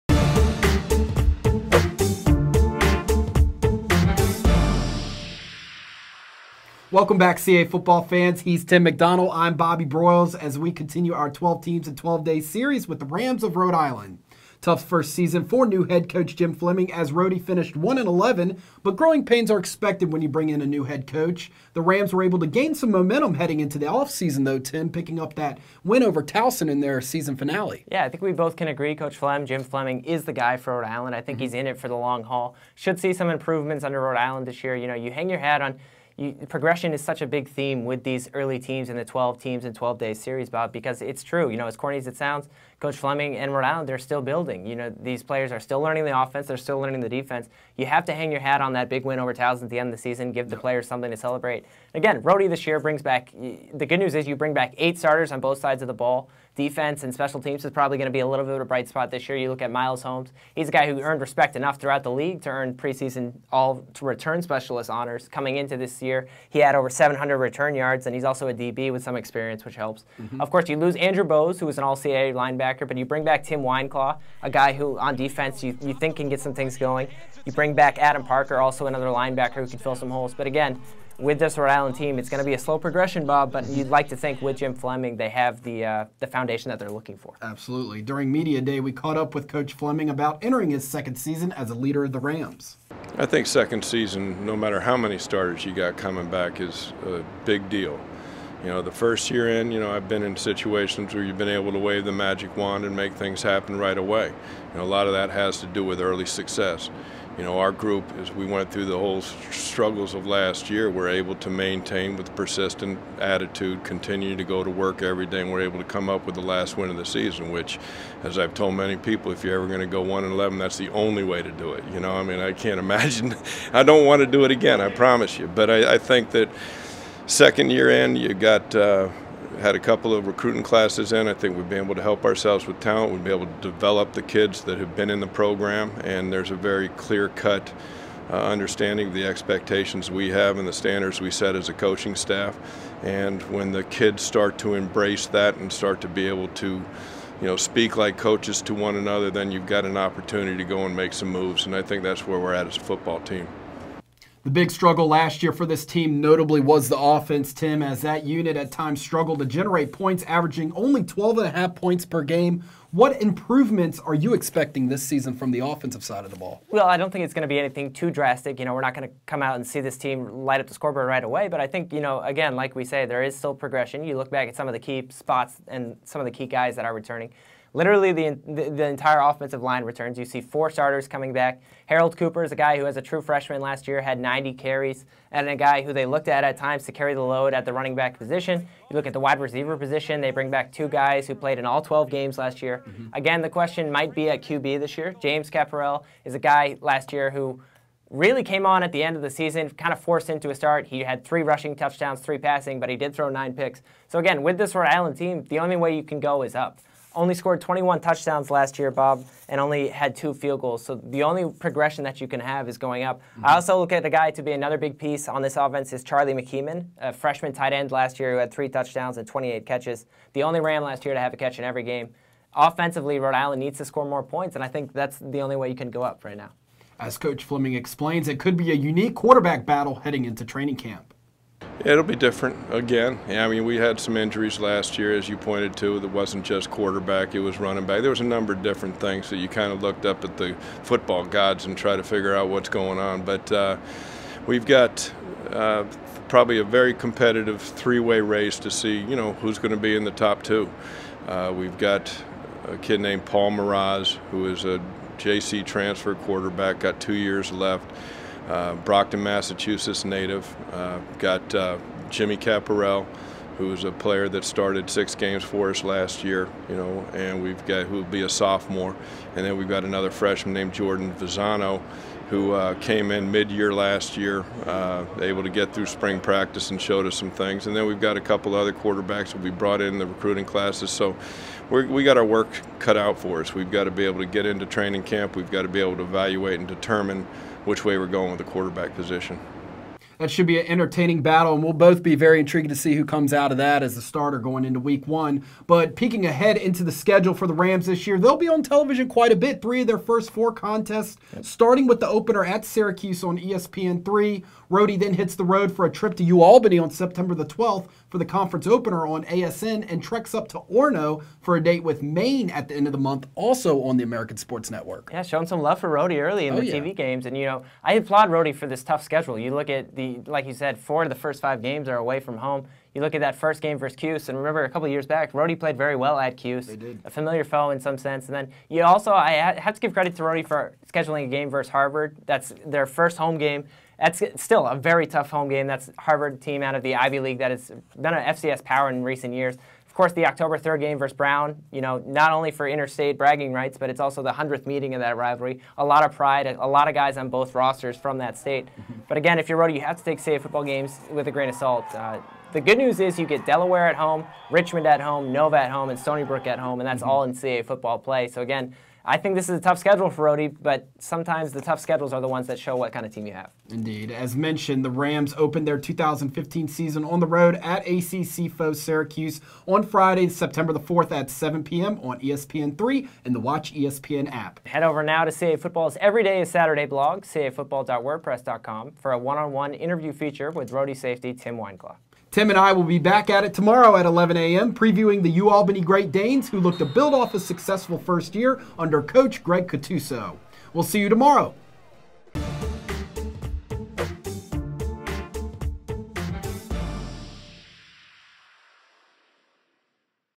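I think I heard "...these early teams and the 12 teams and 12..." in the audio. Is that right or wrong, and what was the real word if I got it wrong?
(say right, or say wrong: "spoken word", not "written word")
right.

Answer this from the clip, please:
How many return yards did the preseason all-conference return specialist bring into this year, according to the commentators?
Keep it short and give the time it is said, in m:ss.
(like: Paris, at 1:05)
over 700, at 1:06.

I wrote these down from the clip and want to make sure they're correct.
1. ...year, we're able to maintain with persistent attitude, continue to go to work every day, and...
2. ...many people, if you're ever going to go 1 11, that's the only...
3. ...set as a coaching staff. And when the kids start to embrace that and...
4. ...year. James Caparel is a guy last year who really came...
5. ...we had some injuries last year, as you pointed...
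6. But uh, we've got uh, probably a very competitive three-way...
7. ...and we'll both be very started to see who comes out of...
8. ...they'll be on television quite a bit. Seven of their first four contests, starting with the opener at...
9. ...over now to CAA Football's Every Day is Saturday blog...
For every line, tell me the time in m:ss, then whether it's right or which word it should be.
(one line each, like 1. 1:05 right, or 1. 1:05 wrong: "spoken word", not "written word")
1. 1:50 right
2. 1:58 right
3. 2:21 right
4. 3:14 right
5. 3:53 right
6. 4:03 right
7. 4:51 wrong: "intrigued", not "started"
8. 4:58 wrong: "Three", not "Seven"
9. 6:14 right.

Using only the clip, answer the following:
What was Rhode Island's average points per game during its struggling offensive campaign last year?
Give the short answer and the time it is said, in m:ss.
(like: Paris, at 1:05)
12.5, at 2:41.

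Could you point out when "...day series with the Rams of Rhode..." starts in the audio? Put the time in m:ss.
0:12.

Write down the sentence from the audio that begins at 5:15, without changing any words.
Yeah, showing some love for Rhody early in oh, the yeah.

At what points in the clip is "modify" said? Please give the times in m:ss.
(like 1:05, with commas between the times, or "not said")
not said.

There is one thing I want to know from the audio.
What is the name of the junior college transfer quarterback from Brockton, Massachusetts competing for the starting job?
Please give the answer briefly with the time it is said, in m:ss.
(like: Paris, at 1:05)
Paul Mraz, at 4:13.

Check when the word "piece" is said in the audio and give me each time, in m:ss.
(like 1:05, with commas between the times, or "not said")
3:34.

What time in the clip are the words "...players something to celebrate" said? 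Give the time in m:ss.
0:50.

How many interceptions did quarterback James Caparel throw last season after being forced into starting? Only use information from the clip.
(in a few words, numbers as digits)
9.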